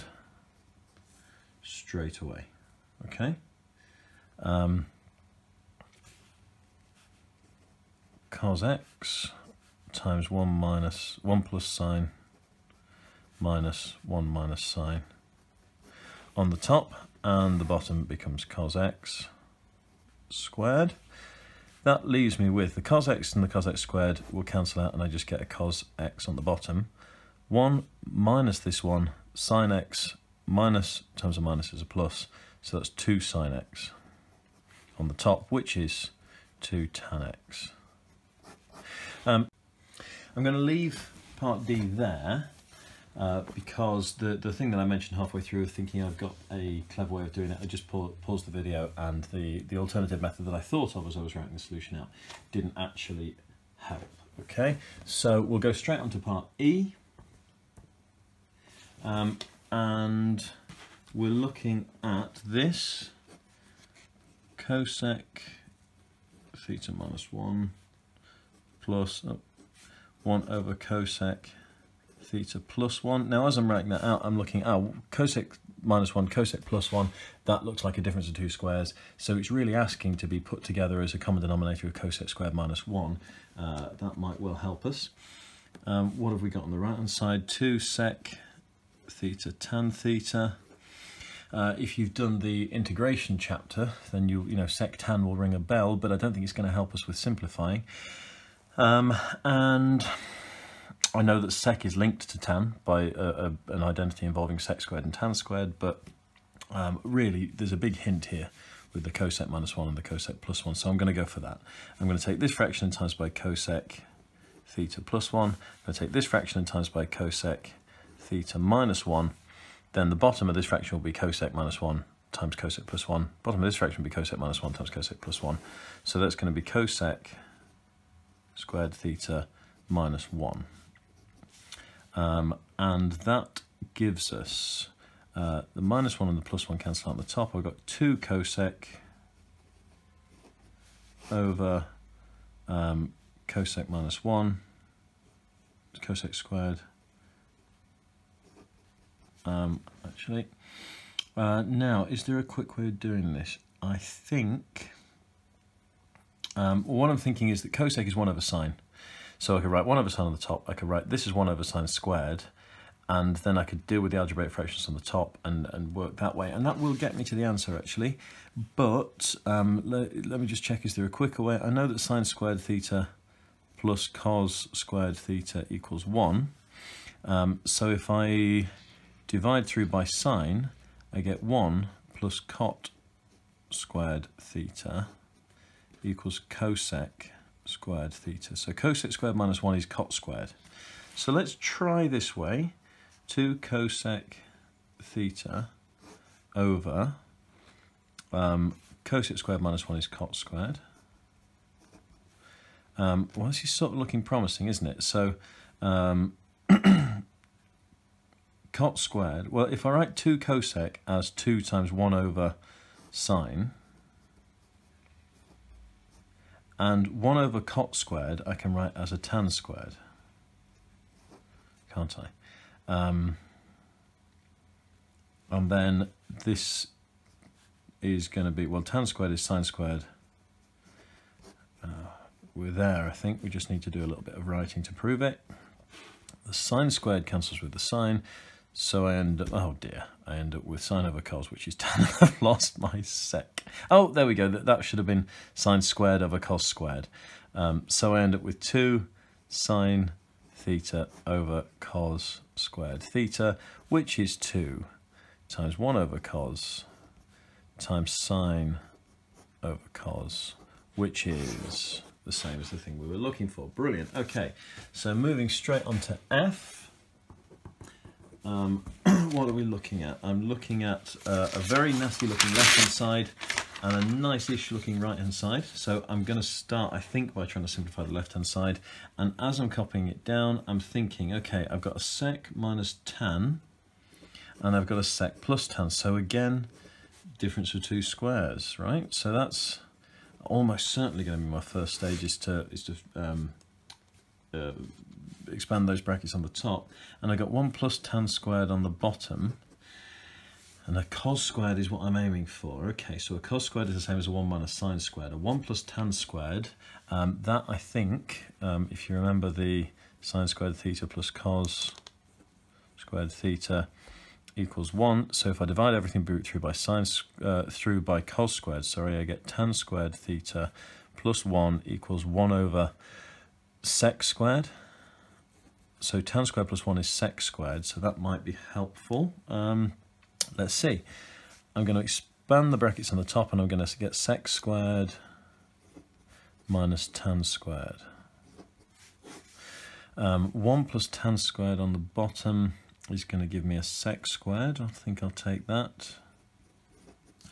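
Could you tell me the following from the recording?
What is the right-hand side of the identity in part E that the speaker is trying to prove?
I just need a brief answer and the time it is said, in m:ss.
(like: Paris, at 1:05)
2 sec theta tan theta, at 1:27.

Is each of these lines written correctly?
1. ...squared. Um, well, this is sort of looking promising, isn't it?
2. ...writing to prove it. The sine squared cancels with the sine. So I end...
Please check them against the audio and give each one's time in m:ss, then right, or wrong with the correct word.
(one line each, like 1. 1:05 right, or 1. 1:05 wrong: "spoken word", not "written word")
1. 3:20 right
2. 3:54 right.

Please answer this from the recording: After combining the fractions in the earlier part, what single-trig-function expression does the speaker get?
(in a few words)
2 tan x.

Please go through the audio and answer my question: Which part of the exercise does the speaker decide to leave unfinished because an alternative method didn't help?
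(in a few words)
Part D.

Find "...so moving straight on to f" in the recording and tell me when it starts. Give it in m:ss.
4:24.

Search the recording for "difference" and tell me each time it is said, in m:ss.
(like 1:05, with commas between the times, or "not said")
1:18, 4:47.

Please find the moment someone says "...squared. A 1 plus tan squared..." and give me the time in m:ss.
5:04.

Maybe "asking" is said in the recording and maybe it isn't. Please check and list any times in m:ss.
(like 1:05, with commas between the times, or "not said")
1:19.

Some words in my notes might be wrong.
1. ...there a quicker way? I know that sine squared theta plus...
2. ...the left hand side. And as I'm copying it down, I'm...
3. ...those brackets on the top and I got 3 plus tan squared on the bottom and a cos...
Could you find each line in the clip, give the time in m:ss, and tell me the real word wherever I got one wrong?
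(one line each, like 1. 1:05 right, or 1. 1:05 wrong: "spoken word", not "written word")
1. 2:50 right
2. 4:38 right
3. 4:55 wrong: "1", not "3".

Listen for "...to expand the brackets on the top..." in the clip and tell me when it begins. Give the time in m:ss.
5:31.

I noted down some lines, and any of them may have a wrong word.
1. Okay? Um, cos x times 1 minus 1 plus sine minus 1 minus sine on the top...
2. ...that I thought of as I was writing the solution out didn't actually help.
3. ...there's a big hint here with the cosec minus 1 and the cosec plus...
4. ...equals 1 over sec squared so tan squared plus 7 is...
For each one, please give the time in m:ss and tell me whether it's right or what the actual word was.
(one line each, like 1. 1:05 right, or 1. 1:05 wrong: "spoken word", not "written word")
1. 0:03 right
2. 0:50 right
3. 1:47 right
4. 5:21 wrong: "1", not "7".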